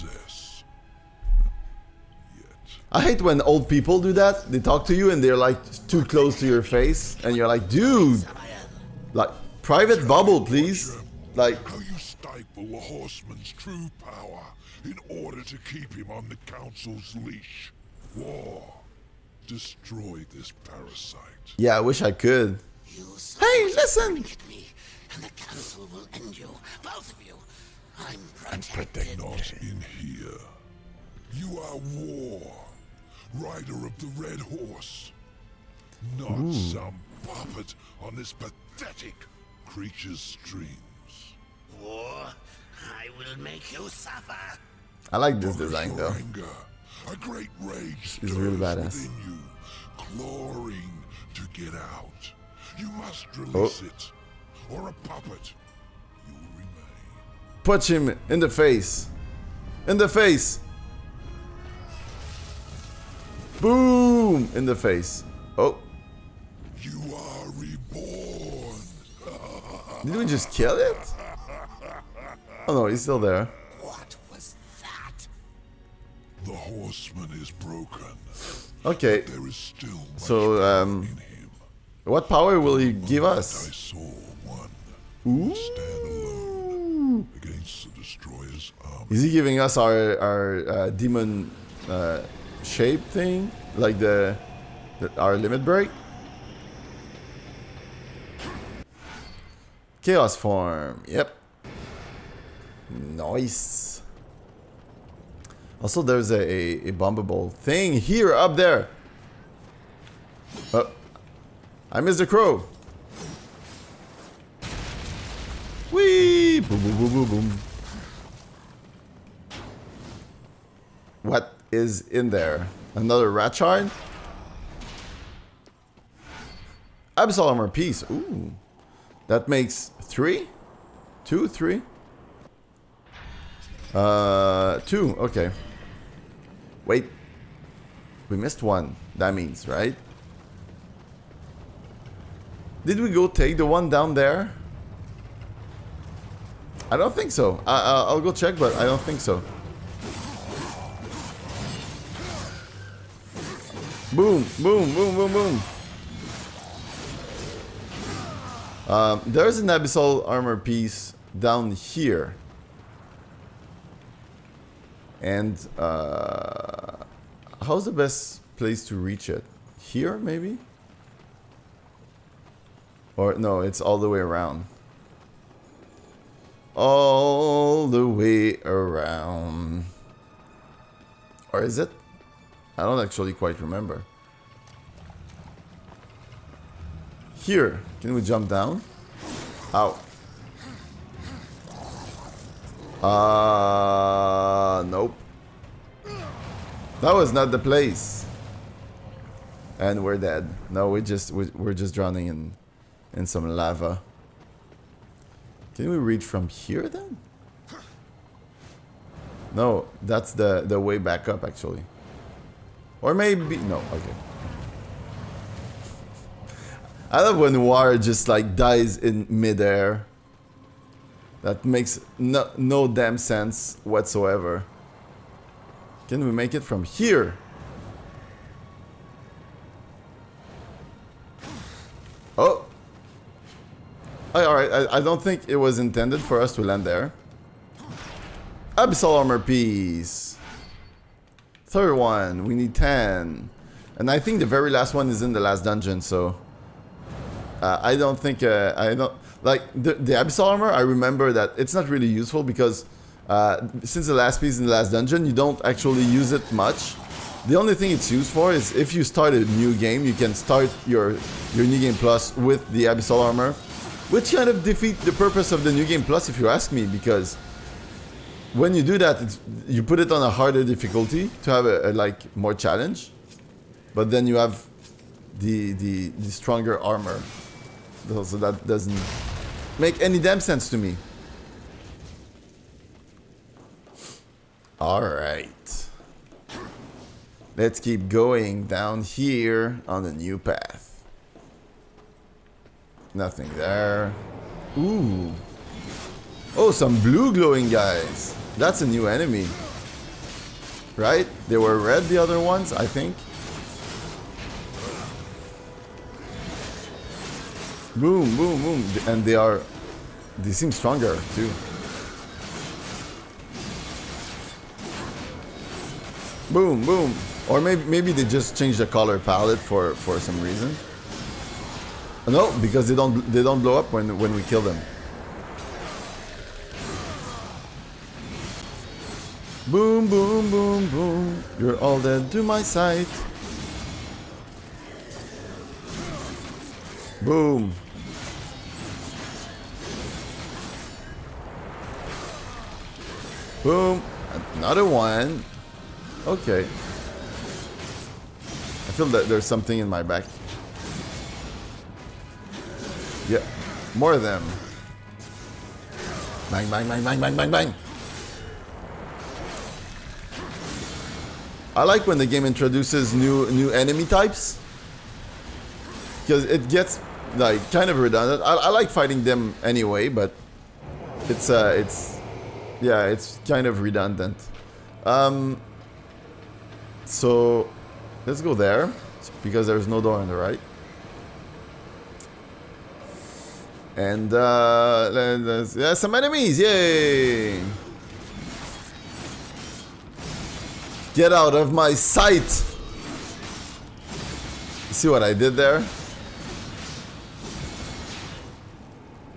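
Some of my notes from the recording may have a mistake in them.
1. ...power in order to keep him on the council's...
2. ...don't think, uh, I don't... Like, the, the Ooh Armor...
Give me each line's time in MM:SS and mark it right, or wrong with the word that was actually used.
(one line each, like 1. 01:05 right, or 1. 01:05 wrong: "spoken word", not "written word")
1. 00:14 right
2. 04:07 wrong: "Abyssal", not "Ooh".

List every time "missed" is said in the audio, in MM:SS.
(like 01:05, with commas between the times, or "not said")
01:51, 02:18.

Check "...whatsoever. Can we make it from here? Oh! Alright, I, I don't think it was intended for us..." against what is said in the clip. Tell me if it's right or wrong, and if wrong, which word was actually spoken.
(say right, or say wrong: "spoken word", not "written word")
right.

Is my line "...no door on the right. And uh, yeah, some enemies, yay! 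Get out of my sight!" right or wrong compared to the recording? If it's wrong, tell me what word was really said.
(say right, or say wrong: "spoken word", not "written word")
right.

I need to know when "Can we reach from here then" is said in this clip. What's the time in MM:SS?
03:25.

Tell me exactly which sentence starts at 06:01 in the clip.
I like when the game introduces new new enemy types.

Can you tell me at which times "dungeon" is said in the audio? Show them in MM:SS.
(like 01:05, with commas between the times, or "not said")
04:05, 04:14.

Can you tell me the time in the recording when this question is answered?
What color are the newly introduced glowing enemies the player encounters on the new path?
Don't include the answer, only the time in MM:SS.
04:57.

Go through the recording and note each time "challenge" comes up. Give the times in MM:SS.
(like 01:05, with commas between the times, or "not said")
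04:32.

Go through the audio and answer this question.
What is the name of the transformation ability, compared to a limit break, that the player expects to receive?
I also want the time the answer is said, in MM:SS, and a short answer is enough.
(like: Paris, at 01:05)
Chaos form, at 01:40.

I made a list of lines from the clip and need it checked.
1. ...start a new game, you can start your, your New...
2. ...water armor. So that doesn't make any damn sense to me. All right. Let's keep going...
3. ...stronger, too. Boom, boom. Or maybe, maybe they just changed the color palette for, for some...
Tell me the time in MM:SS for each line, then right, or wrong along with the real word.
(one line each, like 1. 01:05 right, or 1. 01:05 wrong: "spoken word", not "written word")
1. 04:19 right
2. 04:36 wrong: "stronger", not "water"
3. 05:10 right.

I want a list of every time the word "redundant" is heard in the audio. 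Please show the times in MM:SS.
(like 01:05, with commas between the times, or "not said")
06:07, 06:13.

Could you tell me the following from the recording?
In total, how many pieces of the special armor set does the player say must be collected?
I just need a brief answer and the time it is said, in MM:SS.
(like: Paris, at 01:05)
10, at 04:02.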